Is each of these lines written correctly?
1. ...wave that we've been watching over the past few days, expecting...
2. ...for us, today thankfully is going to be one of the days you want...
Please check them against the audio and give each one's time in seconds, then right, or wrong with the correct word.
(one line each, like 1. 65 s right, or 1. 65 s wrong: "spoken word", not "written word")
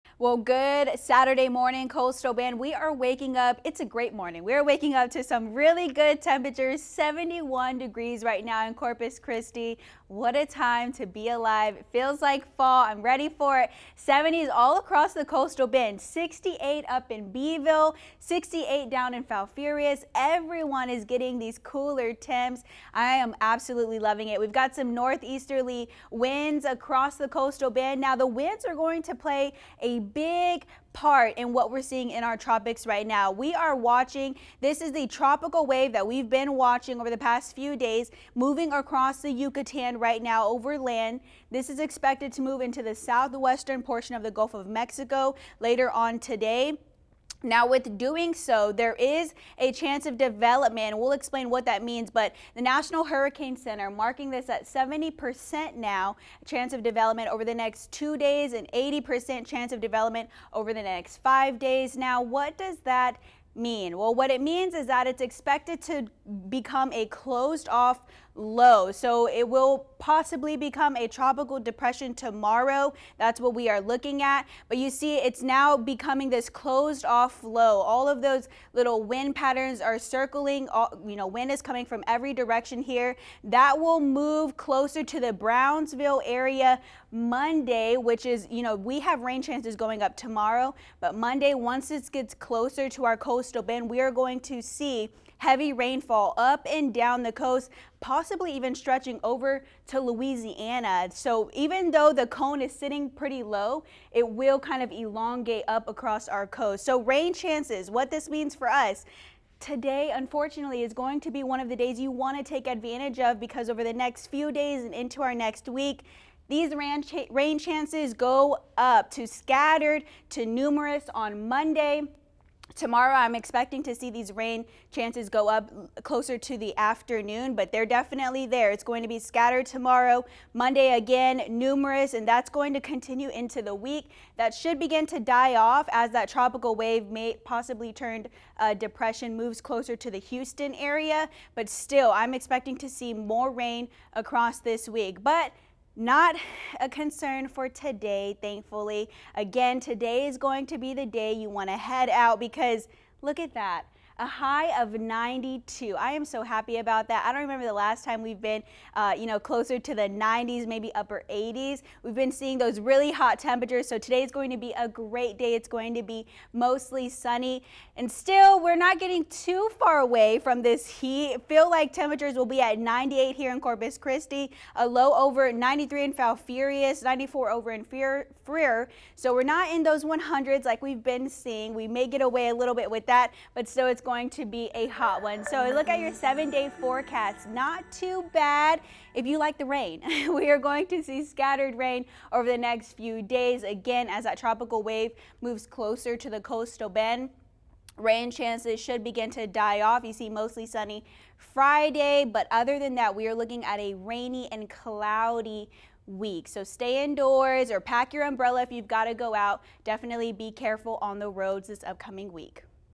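1. 35 s wrong: "moving", not "expecting"
2. 108 s wrong: "unfortunately", not "thankfully".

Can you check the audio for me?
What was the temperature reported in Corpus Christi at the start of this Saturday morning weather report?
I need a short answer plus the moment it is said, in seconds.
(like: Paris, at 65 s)
71 degrees, at 6 s.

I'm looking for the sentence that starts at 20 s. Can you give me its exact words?
Everyone is getting these cooler temps.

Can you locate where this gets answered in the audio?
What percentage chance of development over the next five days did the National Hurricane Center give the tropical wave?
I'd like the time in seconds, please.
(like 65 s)
58 s.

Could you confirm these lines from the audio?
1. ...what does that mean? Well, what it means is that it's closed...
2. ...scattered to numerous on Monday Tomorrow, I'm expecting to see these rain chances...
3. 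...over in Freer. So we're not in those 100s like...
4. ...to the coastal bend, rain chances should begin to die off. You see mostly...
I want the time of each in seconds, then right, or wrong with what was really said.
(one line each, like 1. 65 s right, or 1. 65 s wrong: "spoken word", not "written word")
1. 62 s wrong: "expected", not "closed"
2. 119 s right
3. 177 s right
4. 196 s right.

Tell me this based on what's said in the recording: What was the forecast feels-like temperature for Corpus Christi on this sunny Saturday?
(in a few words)
98.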